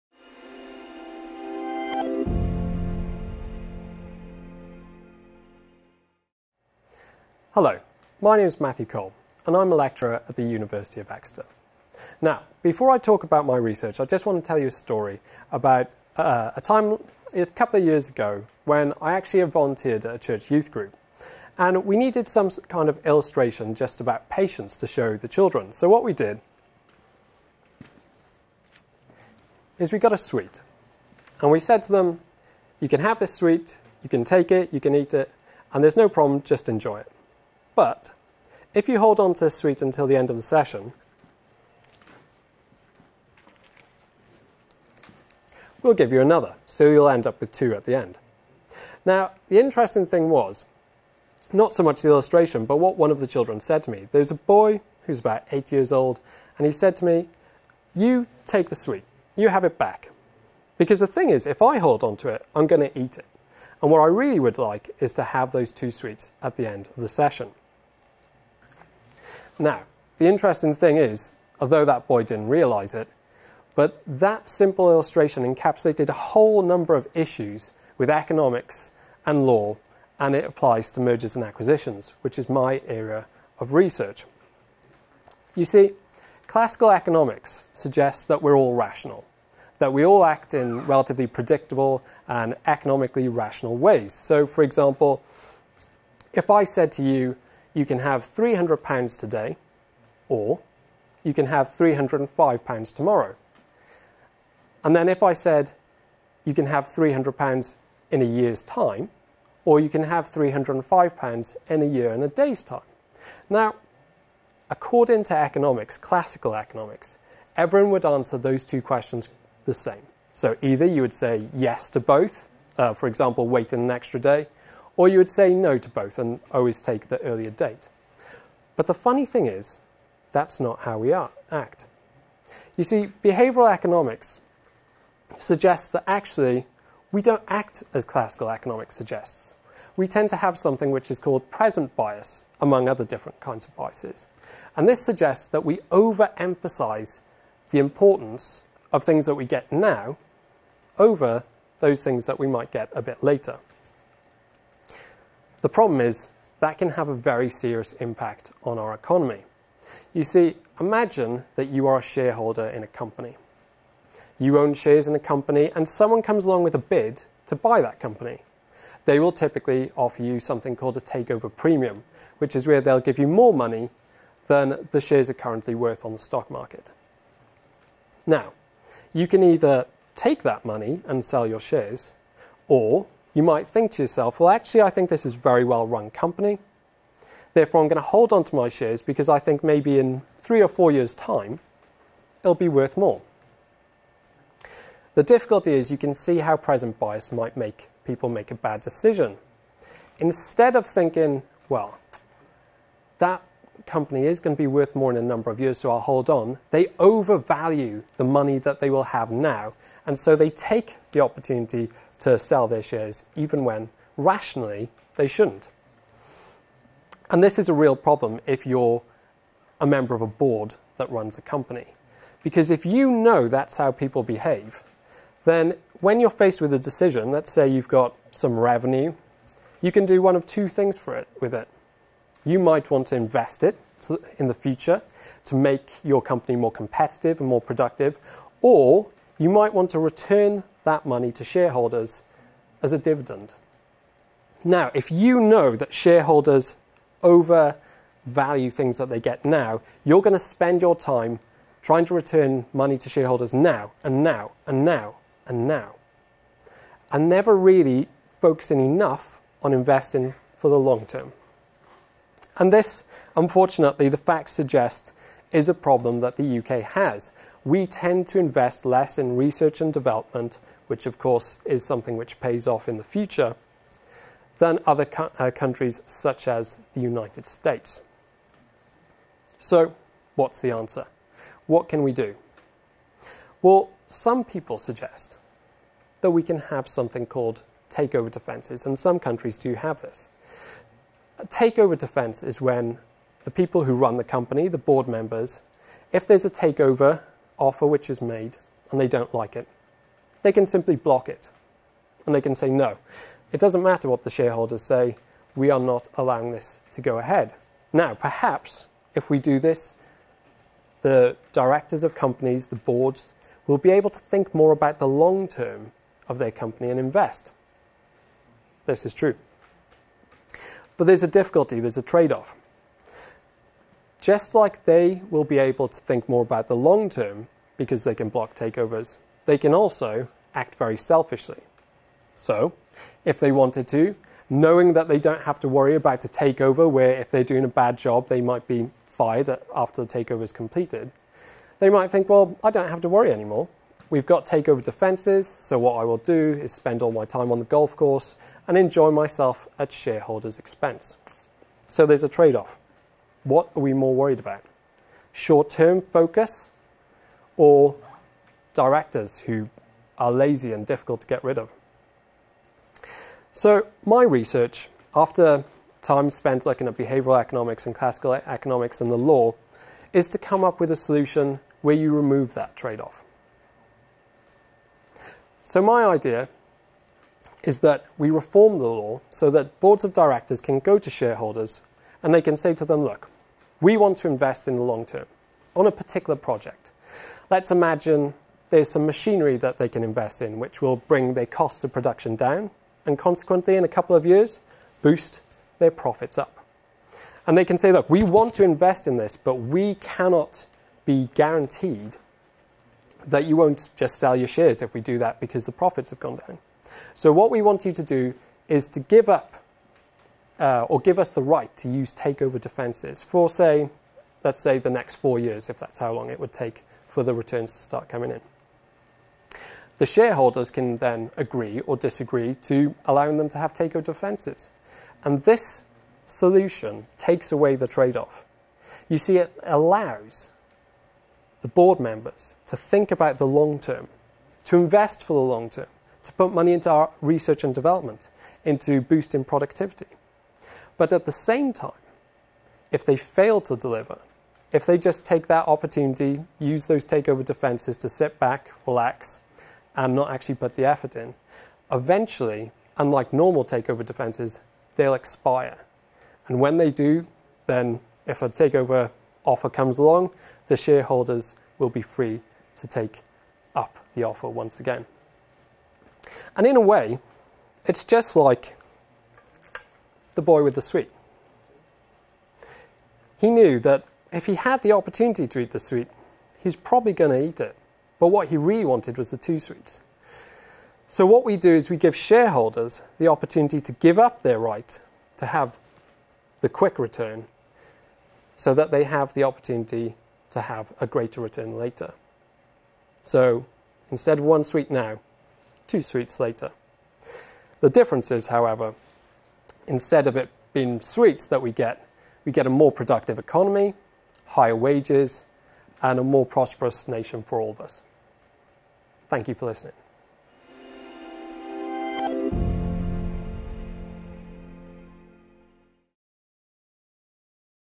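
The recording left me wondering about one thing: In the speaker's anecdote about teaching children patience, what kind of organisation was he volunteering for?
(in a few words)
church youth group.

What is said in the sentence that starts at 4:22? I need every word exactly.
And this, unfortunately, the facts suggest is a problem that the UK has.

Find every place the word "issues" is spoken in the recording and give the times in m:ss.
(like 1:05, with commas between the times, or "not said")
1:17.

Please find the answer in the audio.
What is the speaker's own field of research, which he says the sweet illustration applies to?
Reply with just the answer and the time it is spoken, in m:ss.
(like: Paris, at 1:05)
mergers and acquisitions, at 1:20.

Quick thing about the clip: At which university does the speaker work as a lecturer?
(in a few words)
University of Exeter.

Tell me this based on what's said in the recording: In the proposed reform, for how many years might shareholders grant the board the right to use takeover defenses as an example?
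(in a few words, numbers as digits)
4 years.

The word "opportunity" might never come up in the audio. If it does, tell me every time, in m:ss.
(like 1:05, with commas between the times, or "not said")
3:31, 7:25, 7:54, 8:03, 8:09.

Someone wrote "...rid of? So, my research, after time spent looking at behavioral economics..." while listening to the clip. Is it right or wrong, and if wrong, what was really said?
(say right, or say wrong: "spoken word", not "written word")
right.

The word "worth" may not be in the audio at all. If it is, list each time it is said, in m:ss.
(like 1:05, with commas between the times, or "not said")
2:55, 3:12, 3:24.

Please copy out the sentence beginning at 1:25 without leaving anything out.
You see, classical economics suggests that we're all rational that we all act in relatively predictable and economically rational ways.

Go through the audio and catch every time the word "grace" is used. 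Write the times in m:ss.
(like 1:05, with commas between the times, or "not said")
not said.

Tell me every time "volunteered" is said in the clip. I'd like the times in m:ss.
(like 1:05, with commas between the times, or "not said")
0:19.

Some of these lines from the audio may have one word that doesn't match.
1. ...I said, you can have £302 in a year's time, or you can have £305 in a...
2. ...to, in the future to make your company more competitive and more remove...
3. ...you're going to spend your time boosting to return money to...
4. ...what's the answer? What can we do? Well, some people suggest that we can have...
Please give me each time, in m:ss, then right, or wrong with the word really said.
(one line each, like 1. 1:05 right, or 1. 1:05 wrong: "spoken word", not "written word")
1. 1:45 wrong: "300", not "302"
2. 3:54 wrong: "productive", not "remove"
3. 4:10 wrong: "trying", not "boosting"
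4. 4:40 right.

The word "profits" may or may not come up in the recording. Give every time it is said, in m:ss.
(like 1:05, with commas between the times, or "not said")
6:35, 6:45.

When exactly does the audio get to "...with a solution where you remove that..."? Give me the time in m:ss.
6:10.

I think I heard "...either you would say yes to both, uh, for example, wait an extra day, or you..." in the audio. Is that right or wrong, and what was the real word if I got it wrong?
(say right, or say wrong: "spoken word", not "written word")
right.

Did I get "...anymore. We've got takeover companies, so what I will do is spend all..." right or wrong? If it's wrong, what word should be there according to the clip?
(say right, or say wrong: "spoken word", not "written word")
wrong: "defenses", not "companies".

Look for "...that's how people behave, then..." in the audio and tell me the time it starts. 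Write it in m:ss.
3:43.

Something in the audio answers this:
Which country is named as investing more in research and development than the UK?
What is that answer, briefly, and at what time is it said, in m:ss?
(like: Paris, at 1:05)
United States, at 4:37.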